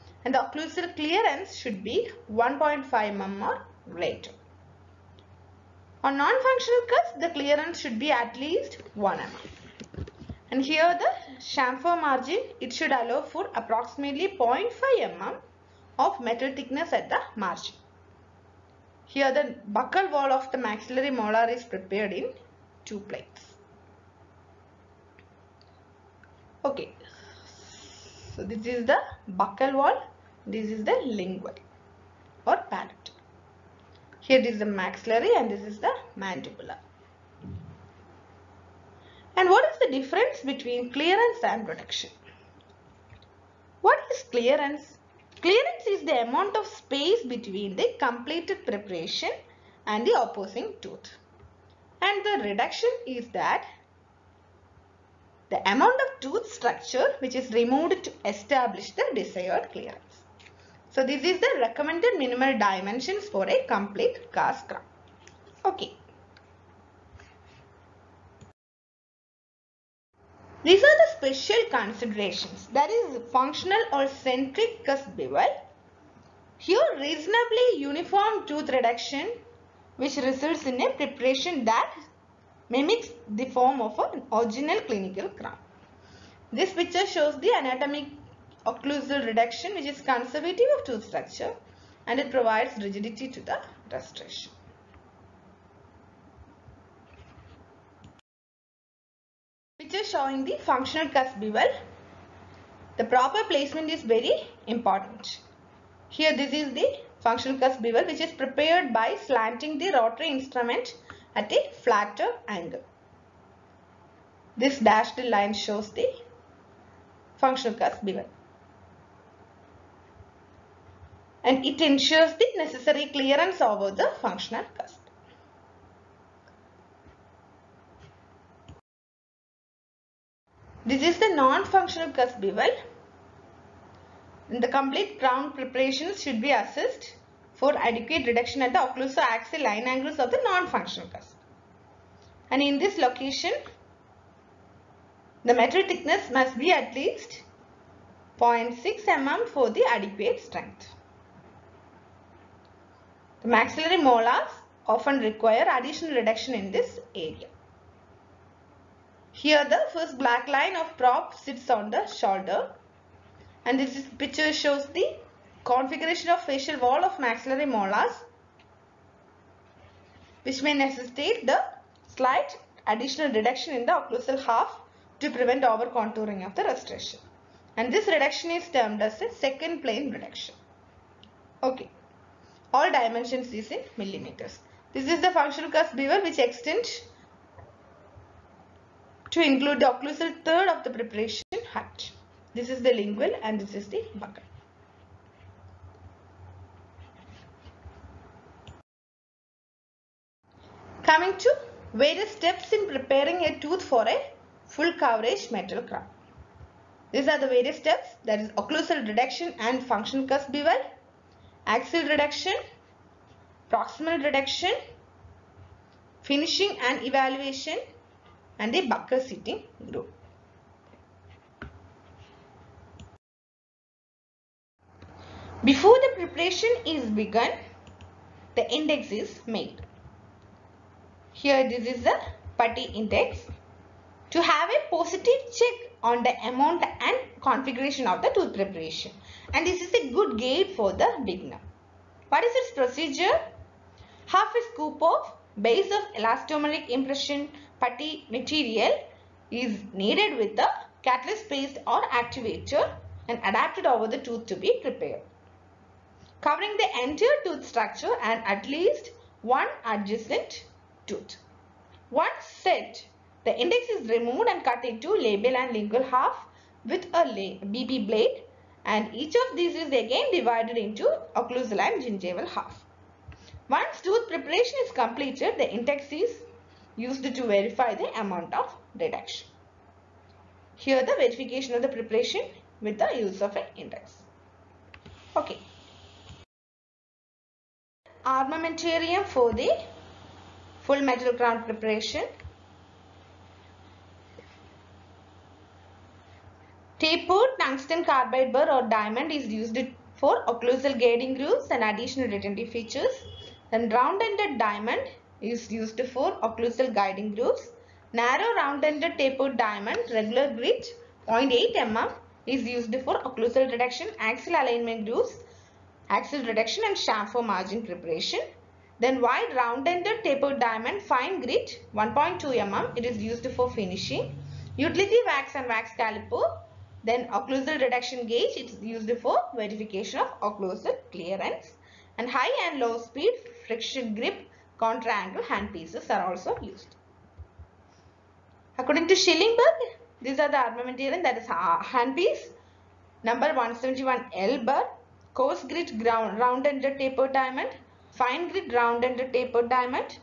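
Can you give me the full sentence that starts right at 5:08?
Narrow round-ended tapered diamond, regular grit 0.8 mm is used for occlusal reduction, axial alignment grooves, axial reduction and chamfer margin preparation.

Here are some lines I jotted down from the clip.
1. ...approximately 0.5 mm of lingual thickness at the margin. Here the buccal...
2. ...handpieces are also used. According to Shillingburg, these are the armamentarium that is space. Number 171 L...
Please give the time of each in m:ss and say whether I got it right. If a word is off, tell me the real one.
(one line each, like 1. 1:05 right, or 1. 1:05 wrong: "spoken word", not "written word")
1. 0:13 wrong: "metal", not "lingual"
2. 5:35 wrong: "handpiece", not "space".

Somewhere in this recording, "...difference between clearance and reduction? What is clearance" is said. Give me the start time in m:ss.
0:39.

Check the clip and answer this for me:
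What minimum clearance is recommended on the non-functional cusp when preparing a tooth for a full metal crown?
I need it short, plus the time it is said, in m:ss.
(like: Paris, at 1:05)
1 mm, at 0:08.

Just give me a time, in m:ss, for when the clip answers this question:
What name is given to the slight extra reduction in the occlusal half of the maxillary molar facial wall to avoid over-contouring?
2:59.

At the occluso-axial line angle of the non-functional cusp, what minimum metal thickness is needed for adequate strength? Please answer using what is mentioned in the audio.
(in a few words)
0.6 mm.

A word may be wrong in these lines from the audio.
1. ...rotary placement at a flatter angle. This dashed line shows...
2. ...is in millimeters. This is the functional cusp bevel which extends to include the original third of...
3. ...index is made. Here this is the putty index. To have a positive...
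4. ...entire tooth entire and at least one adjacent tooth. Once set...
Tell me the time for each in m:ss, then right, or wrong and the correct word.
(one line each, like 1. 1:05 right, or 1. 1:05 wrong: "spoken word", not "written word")
1. 1:49 wrong: "instrument", not "placement"
2. 3:03 wrong: "occlusal", not "original"
3. 3:48 right
4. 4:17 wrong: "structure", not "entire".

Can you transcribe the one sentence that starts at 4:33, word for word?
Once tooth preparation is completed, the index is used to verify the amount of reduction.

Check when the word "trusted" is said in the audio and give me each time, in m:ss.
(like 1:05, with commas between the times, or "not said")
not said.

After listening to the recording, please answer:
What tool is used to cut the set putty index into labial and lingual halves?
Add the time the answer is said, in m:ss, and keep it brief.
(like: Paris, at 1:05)
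BP blade, at 4:27.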